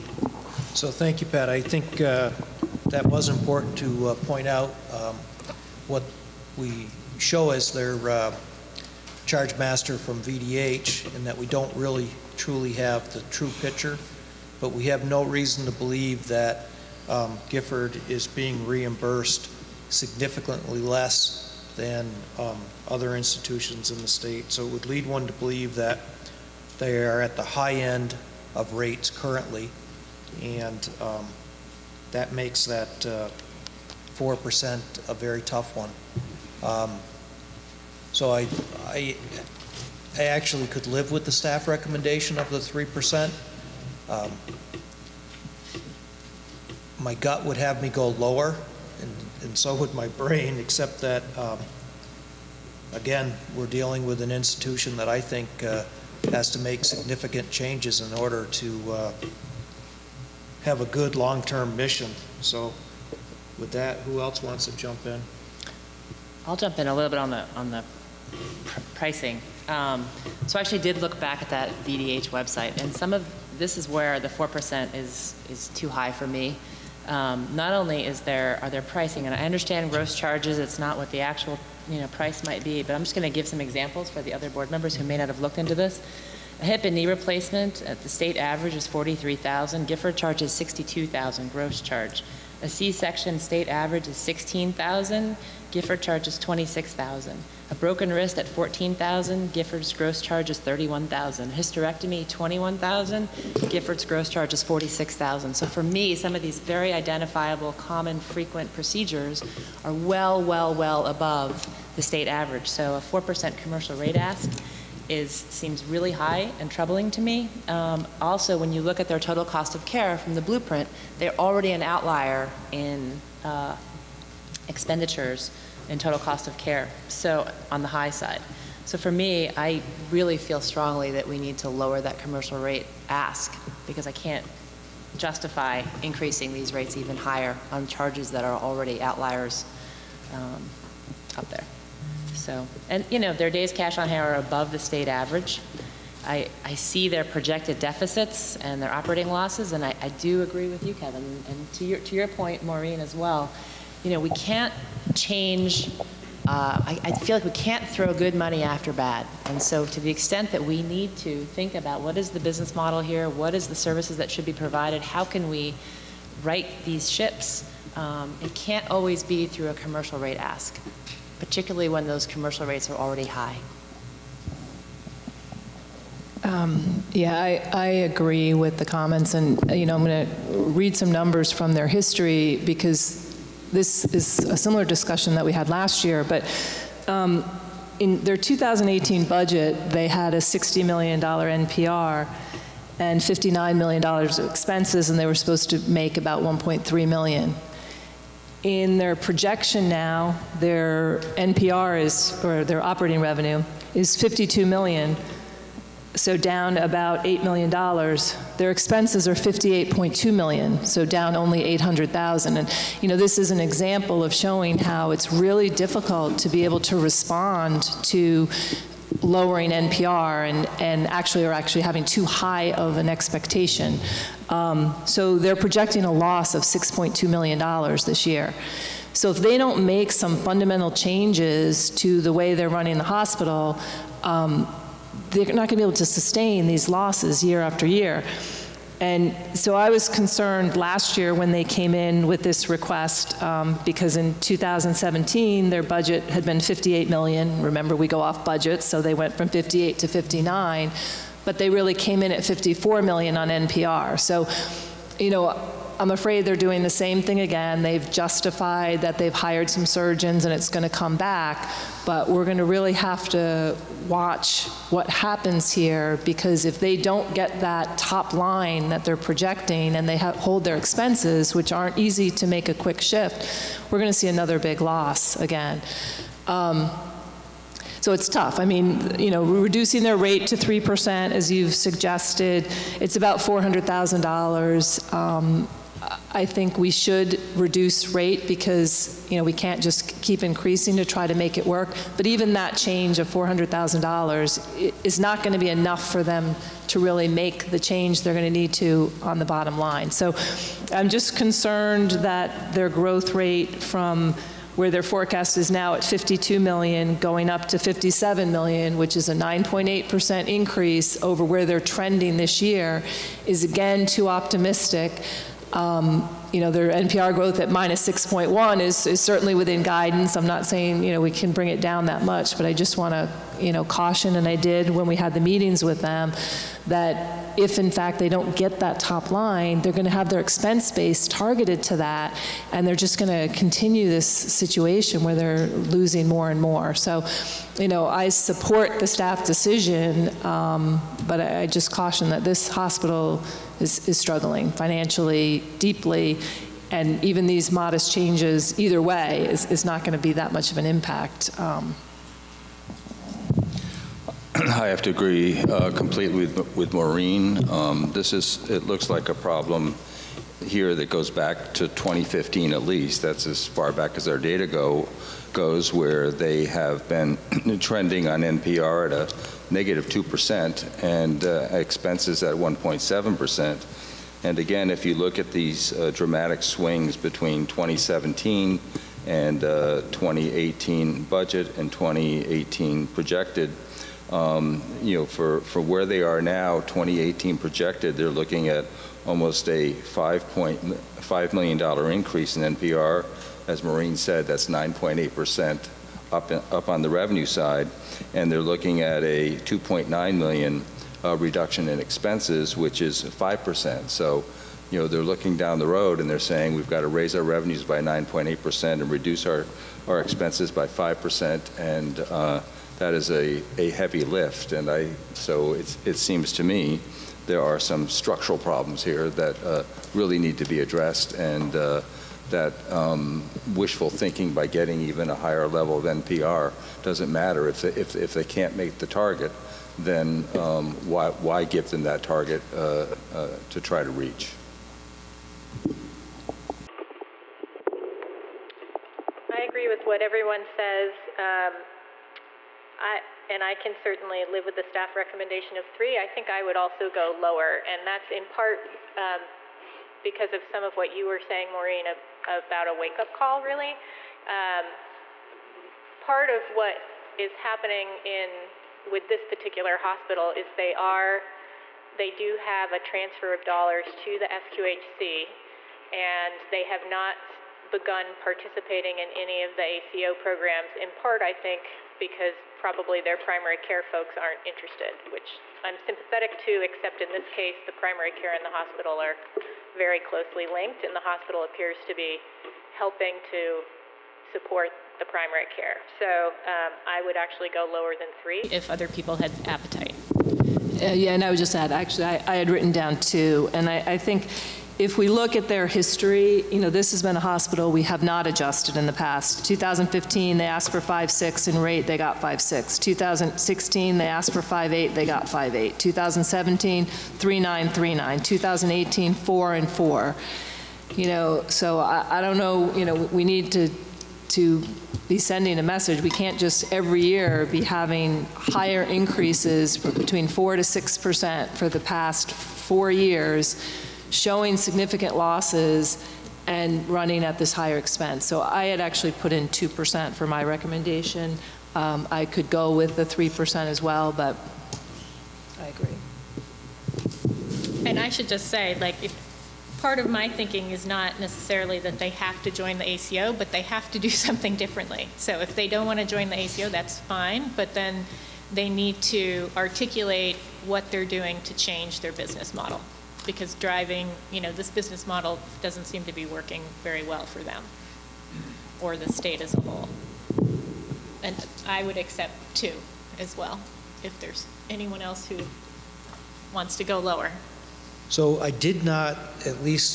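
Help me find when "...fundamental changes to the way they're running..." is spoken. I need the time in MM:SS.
03:50.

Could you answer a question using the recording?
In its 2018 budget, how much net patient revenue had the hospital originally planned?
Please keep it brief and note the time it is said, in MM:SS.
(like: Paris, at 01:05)
$60 million, at 03:10.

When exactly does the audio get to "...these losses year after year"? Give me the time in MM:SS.
03:56.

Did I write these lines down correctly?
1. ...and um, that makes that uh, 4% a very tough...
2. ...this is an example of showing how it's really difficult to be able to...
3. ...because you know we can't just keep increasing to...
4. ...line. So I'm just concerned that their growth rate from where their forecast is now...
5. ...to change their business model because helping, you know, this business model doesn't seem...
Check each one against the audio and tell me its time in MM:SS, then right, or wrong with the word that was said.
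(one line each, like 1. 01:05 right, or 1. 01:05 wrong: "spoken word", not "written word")
1. 00:30 right
2. 03:33 right
3. 04:48 right
4. 04:59 right
5. 09:11 wrong: "driving", not "helping".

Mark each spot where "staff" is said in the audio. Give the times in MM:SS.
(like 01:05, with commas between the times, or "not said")
00:41, 05:39, 07:24.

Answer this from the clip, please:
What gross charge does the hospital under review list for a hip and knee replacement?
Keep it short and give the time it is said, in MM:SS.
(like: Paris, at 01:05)
62,000, at 01:30.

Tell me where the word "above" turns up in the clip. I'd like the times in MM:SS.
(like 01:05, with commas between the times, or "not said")
01:51, 02:24.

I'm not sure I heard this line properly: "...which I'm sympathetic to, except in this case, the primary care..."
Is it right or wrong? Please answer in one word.
right.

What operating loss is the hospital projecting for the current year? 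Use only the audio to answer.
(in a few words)
$6.2 million.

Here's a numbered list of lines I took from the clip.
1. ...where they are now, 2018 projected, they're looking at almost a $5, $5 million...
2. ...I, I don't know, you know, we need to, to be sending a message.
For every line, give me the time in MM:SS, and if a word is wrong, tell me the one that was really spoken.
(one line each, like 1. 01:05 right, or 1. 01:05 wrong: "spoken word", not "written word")
1. 06:25 right
2. 08:31 right.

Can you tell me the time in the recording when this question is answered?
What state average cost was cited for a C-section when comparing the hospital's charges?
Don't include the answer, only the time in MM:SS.
01:34.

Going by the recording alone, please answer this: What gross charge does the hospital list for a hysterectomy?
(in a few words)
46,000.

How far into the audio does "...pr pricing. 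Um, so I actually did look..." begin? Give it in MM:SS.
01:08.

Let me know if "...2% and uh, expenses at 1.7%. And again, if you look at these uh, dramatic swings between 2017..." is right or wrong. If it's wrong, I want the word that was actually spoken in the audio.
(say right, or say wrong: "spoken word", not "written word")
right.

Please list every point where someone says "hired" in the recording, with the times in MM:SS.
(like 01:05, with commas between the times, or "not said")
04:19.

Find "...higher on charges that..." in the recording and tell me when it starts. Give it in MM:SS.
02:17.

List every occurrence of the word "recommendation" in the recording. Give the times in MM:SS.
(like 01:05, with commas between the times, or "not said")
00:41, 07:25, 08:50.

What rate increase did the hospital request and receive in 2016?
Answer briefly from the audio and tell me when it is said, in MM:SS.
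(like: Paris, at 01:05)
5.8, at 08:24.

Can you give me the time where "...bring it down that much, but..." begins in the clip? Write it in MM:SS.
05:21.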